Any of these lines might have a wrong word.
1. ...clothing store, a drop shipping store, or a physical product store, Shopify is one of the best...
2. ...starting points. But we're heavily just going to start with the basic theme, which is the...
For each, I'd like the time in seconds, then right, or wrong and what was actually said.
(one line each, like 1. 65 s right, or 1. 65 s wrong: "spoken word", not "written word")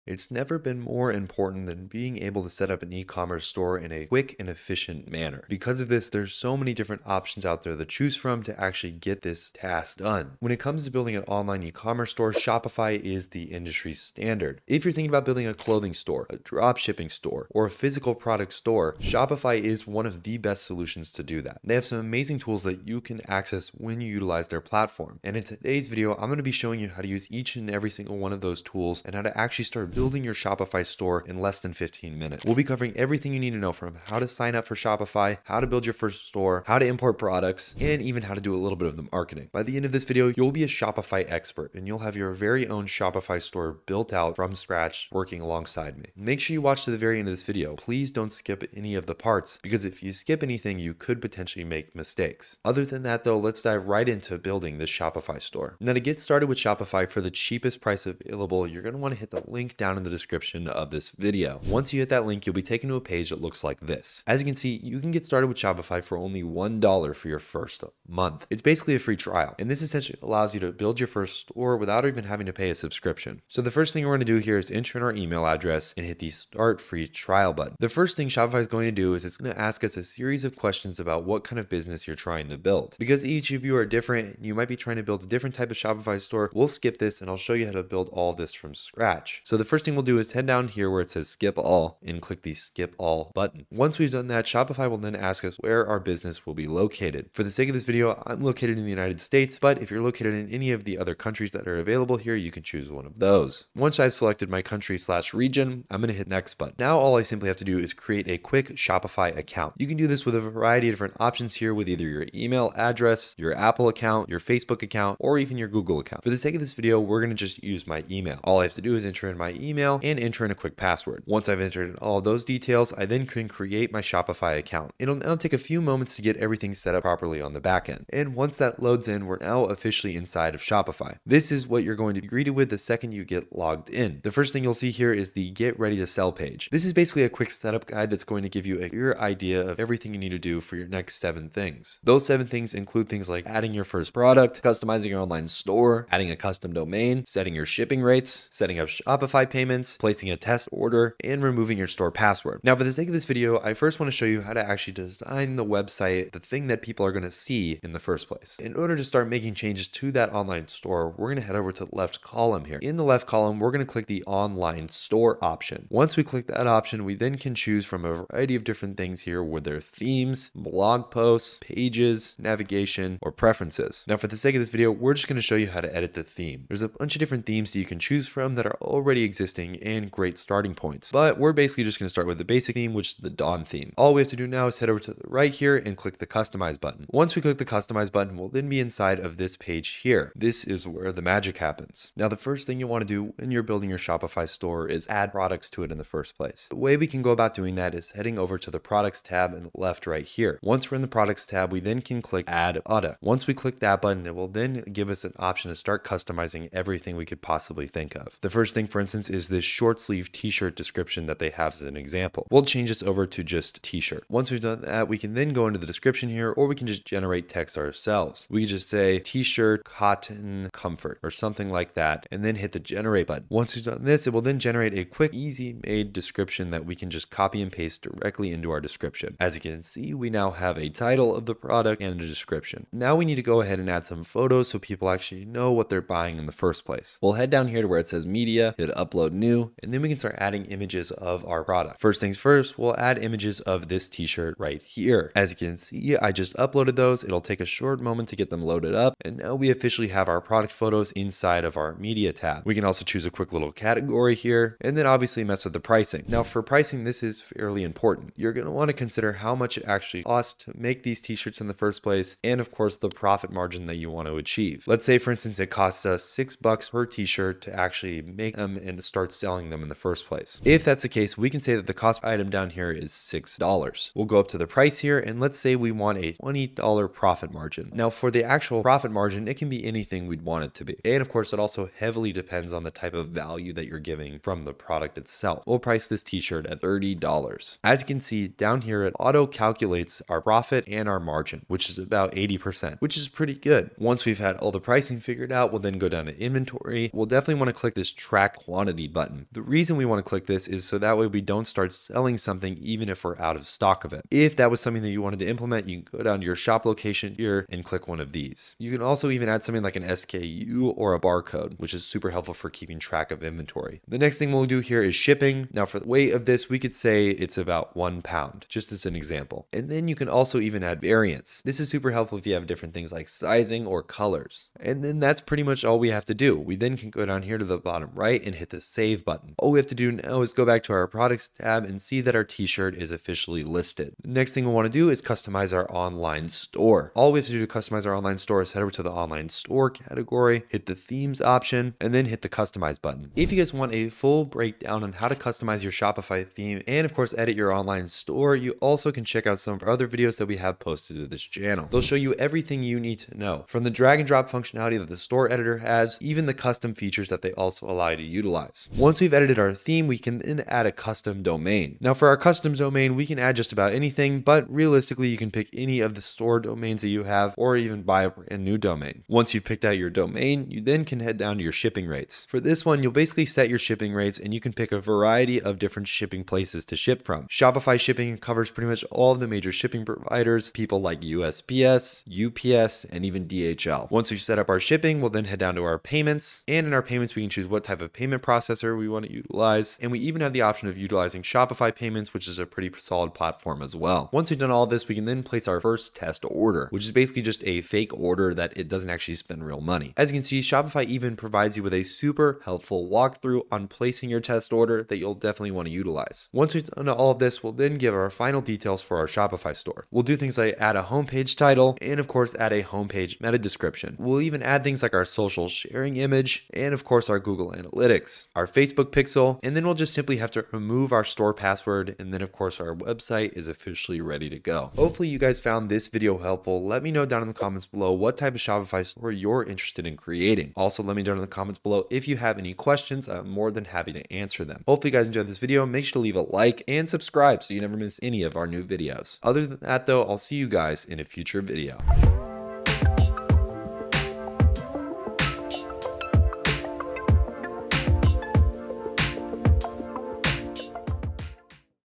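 1. 15 s right
2. 180 s wrong: "basically", not "heavily".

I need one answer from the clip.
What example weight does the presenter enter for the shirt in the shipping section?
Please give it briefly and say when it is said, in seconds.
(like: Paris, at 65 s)
1 pound, at 317 s.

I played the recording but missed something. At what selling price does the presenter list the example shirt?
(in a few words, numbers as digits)
$30.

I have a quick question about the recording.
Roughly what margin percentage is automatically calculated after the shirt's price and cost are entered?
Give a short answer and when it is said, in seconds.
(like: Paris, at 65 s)
80%, at 292 s.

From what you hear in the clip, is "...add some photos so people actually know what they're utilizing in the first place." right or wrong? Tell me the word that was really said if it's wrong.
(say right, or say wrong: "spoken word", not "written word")
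wrong: "buying", not "utilizing".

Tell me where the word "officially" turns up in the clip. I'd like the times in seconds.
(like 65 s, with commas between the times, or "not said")
129 s, 249 s, 333 s, 423 s.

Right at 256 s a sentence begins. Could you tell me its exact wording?
Now for pricing, this is fairly important.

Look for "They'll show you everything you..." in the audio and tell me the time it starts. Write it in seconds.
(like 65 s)
351 s.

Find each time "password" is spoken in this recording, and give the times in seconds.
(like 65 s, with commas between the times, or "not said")
120 s, 152 s, 421 s.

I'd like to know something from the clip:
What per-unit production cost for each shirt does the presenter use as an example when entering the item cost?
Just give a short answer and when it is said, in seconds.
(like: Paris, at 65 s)
$6, at 266 s.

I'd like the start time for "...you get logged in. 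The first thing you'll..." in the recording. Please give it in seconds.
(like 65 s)
133 s.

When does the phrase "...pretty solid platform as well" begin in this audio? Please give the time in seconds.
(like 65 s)
392 s.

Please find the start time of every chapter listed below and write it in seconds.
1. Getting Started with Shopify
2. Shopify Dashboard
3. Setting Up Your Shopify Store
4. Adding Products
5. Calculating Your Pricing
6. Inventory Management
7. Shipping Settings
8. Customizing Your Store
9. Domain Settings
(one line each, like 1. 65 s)
1. 56 s
2. 129 s
3. 159 s
4. 192 s
5. 256 s
6. 294 s
7. 314 s
8. 335 s
9. 359 s.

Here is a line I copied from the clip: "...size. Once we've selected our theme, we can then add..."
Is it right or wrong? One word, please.
wrong.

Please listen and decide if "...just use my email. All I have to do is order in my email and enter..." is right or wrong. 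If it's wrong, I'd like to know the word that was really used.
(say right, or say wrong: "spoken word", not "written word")
wrong: "enter", not "order".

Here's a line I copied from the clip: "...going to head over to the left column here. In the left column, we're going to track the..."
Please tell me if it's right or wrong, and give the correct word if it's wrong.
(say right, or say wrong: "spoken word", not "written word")
wrong: "click", not "track".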